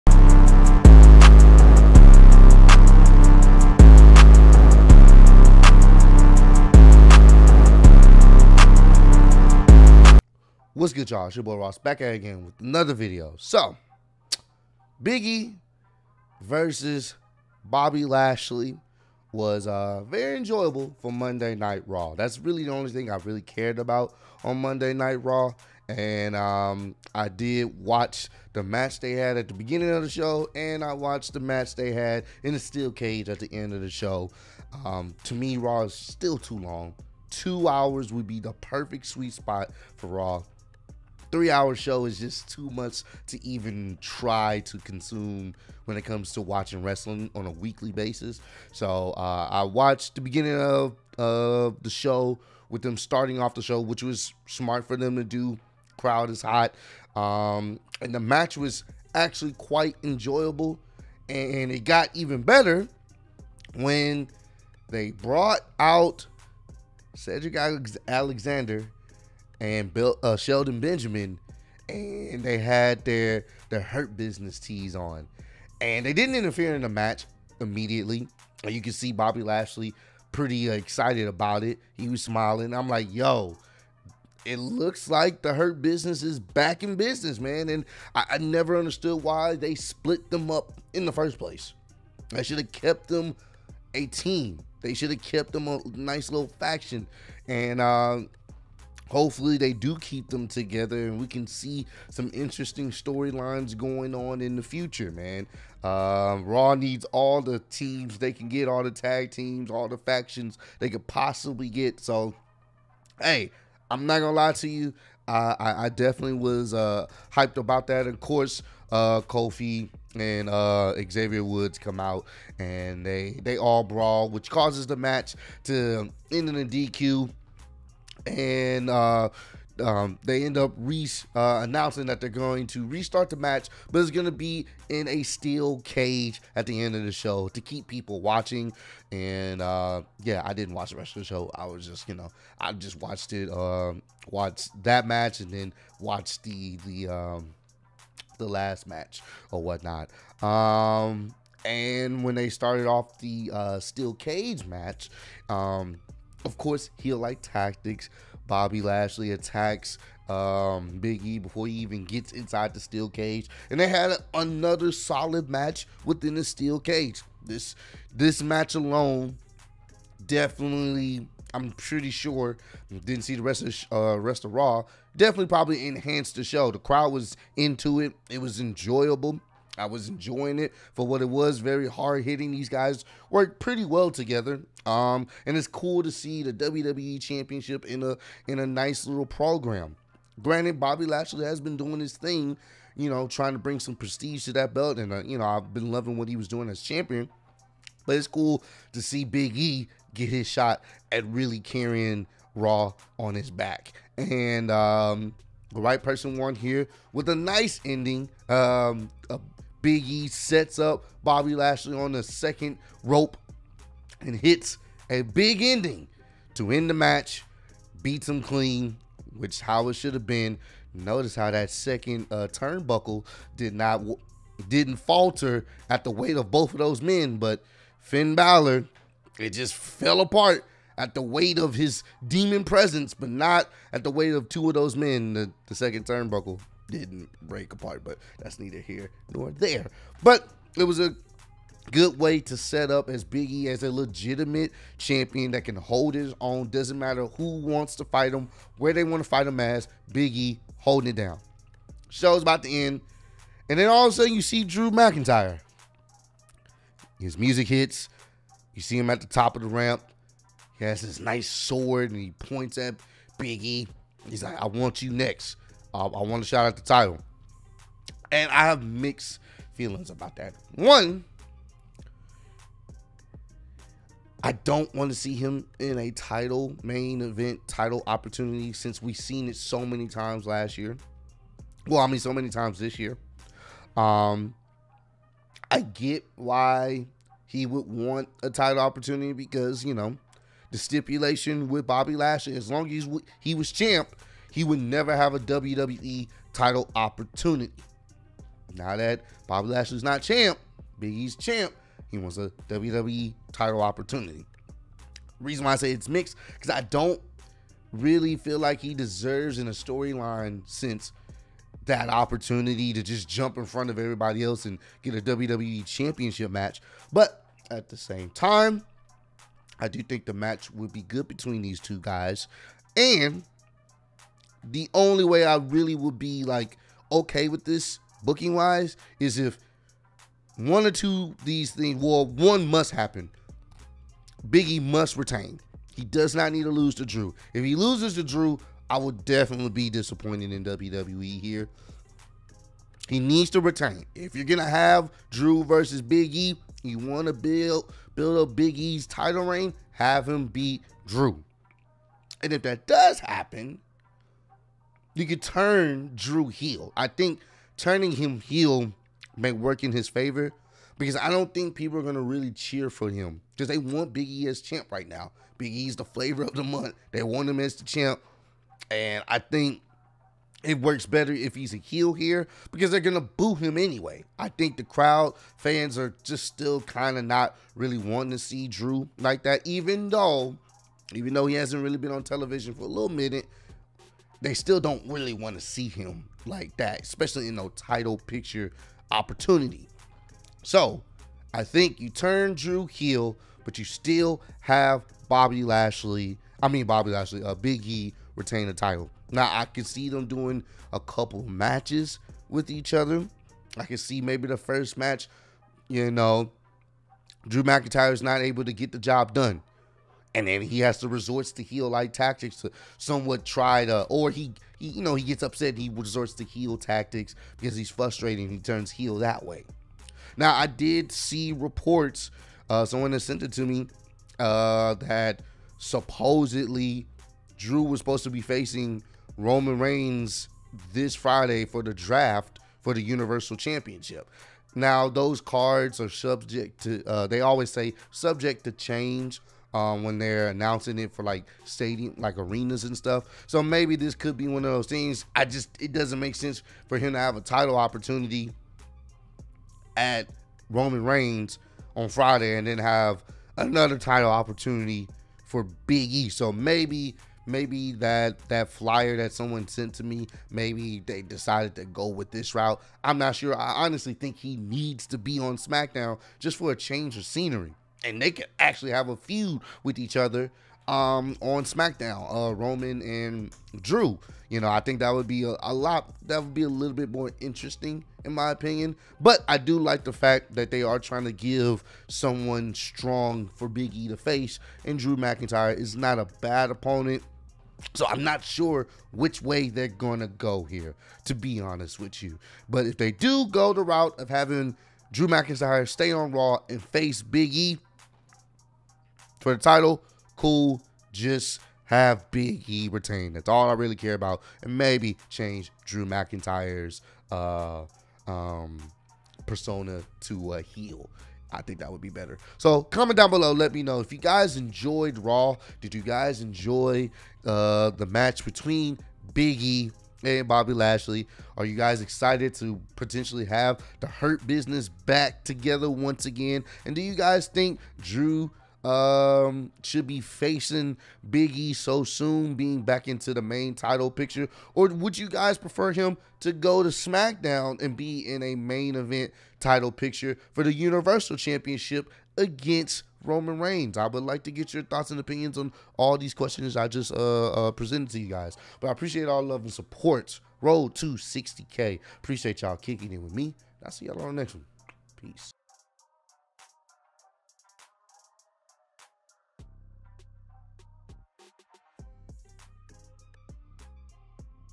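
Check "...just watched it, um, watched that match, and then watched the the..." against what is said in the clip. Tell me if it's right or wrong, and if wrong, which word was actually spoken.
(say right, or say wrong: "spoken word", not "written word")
right.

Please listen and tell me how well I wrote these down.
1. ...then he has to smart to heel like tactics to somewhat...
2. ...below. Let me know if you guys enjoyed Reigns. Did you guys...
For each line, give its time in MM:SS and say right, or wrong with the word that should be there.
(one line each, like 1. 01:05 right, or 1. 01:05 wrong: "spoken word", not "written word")
1. 06:50 wrong: "resort", not "smart"
2. 08:33 wrong: "Raw", not "Reigns".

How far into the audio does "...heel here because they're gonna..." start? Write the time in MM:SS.
06:11.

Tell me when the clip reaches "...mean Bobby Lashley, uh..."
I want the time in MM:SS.
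06:36.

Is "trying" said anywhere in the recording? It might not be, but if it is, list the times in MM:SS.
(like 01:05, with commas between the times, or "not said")
03:13, 08:00.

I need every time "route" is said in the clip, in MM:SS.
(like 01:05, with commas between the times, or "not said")
07:42, 08:13.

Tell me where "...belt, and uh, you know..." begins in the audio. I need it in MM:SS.
03:14.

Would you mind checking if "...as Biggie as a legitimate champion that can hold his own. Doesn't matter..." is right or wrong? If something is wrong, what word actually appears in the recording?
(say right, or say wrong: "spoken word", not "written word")
right.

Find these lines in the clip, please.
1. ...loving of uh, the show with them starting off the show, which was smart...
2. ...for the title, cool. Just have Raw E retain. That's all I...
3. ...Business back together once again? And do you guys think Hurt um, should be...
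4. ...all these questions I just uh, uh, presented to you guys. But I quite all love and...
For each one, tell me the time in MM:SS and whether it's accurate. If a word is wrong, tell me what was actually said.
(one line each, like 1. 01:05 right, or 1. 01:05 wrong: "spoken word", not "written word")
1. 00:50 wrong: "beginning", not "loving"
2. 08:19 wrong: "Big", not "Raw"
3. 08:44 wrong: "Drew", not "Hurt"
4. 09:05 wrong: "appreciate", not "quite".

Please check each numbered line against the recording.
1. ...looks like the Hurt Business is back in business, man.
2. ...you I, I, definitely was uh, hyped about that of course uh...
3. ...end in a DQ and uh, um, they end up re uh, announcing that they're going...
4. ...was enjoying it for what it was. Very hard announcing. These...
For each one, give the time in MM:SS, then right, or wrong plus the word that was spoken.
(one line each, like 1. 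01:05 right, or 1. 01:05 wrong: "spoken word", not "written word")
1. 01:24 right
2. 01:54 right
3. 02:06 right
4. 02:59 wrong: "hitting", not "announcing".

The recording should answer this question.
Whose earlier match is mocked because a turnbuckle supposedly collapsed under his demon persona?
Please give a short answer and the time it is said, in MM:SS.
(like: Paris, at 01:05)
Finn Balor, at 03:47.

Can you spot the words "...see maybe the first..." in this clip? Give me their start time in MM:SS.
06:43.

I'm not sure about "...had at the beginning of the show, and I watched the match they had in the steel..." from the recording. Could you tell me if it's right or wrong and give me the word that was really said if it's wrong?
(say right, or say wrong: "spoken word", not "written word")
right.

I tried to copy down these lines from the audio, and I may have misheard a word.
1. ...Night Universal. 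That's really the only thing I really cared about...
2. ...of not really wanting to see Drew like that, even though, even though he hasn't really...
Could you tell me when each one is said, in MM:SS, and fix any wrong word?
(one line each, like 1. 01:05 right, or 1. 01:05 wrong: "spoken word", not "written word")
1. 00:21 wrong: "Raw", not "Universal"
2. 06:17 right.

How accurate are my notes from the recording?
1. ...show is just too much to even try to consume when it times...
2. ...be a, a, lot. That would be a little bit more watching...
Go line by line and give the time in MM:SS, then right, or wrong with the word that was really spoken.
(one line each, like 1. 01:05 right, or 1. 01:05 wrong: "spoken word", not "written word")
1. 00:41 wrong: "comes", not "times"
2. 07:55 wrong: "interesting", not "watching".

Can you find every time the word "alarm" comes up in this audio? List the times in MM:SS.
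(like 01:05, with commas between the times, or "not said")
not said.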